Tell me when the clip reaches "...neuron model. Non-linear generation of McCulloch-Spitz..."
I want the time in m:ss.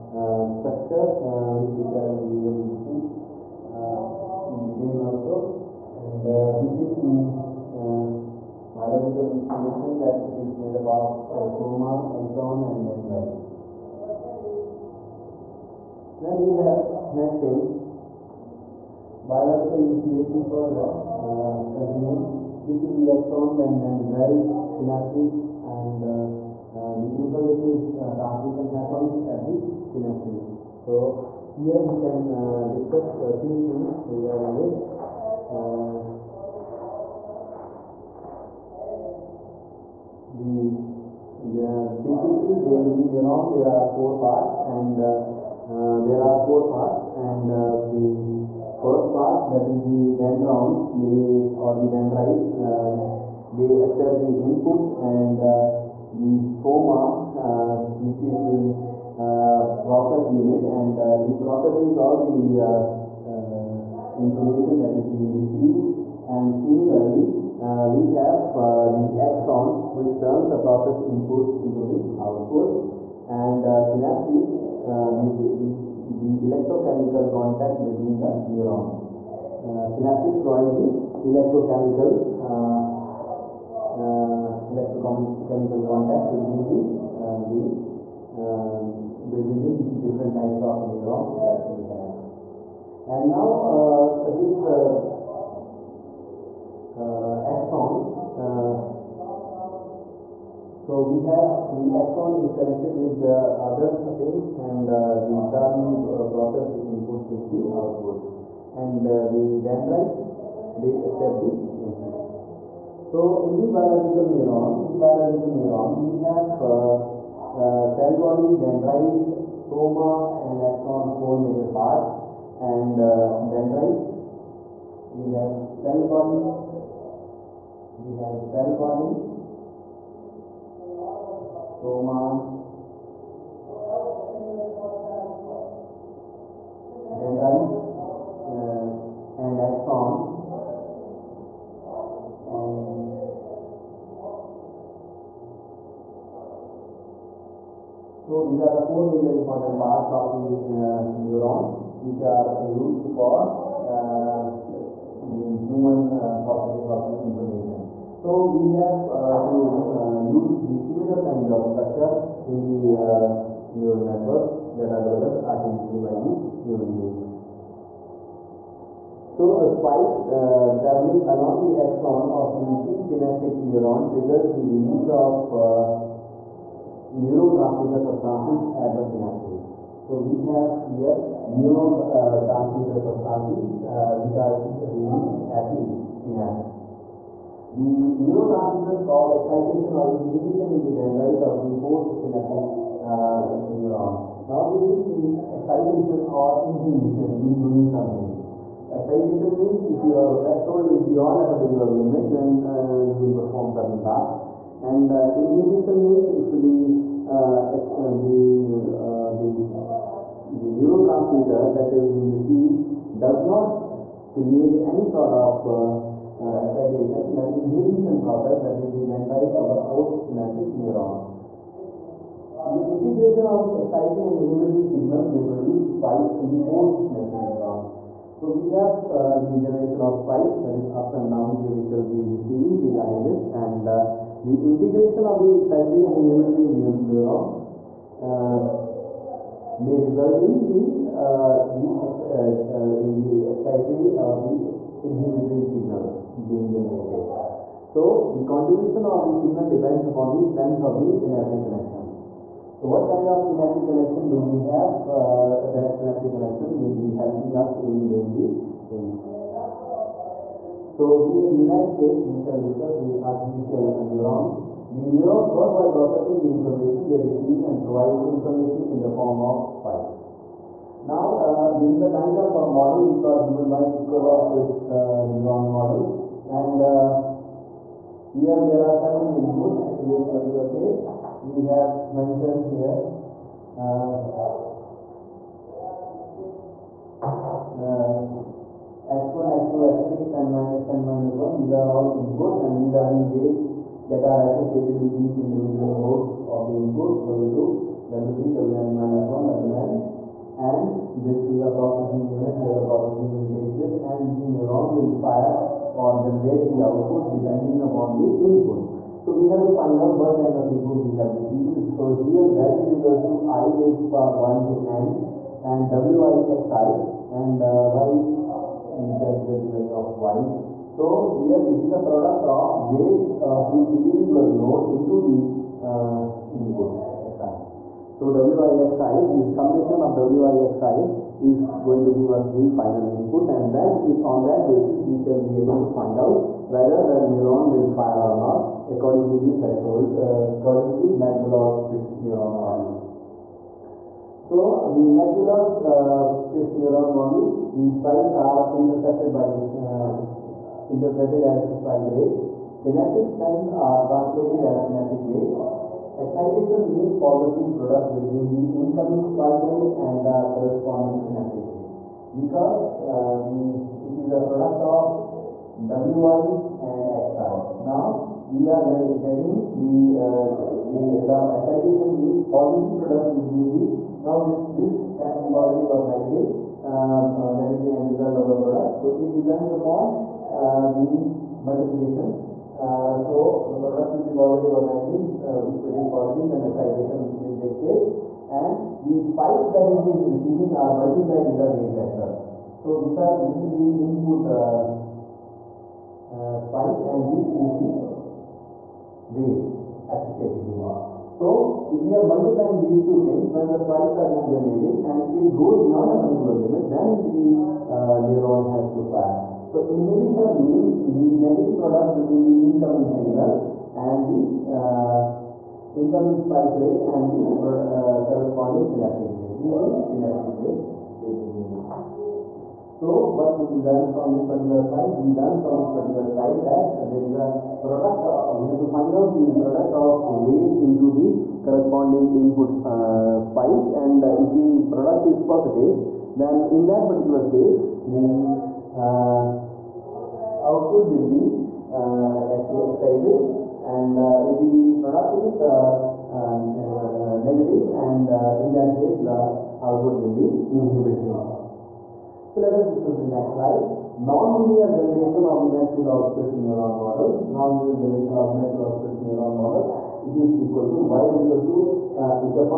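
7:36.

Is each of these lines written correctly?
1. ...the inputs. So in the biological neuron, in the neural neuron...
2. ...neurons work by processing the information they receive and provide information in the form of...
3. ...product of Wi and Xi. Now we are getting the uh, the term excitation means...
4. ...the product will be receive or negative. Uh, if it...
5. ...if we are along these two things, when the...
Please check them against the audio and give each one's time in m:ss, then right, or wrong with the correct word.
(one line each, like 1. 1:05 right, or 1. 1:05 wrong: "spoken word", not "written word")
1. 1:51 wrong: "biological", not "neural"
2. 4:25 right
3. 6:04 right
4. 6:23 wrong: "positive", not "receive"
5. 6:41 wrong: "multiplying", not "along".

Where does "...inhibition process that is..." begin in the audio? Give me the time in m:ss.
3:37.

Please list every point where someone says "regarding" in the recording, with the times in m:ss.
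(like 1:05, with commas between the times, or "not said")
0:34, 3:52.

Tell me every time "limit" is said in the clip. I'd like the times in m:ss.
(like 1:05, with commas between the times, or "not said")
3:21, 6:46.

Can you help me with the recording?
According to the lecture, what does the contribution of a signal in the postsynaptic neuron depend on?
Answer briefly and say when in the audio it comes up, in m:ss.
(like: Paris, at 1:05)
strength of the synaptic connection, at 4:10.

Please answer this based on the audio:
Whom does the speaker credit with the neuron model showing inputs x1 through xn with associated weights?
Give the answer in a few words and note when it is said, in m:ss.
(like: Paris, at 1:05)
Piccola, at 4:33.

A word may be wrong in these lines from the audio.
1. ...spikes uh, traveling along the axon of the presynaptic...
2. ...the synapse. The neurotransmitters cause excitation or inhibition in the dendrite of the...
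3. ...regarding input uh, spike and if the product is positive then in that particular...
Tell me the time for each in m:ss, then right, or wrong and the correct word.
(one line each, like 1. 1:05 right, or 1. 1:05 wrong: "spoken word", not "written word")
1. 2:49 right
2. 3:05 right
3. 7:11 wrong: "corresponding", not "regarding".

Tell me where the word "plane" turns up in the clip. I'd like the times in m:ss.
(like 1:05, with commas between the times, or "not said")
not said.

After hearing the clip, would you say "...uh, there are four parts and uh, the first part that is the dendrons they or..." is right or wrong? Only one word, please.
right.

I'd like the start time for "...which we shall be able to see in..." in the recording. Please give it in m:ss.
0:01.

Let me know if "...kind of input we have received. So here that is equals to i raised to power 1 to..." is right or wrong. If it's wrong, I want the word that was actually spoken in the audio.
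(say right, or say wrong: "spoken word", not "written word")
right.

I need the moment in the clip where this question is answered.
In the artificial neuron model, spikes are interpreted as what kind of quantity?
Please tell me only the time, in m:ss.
5:51.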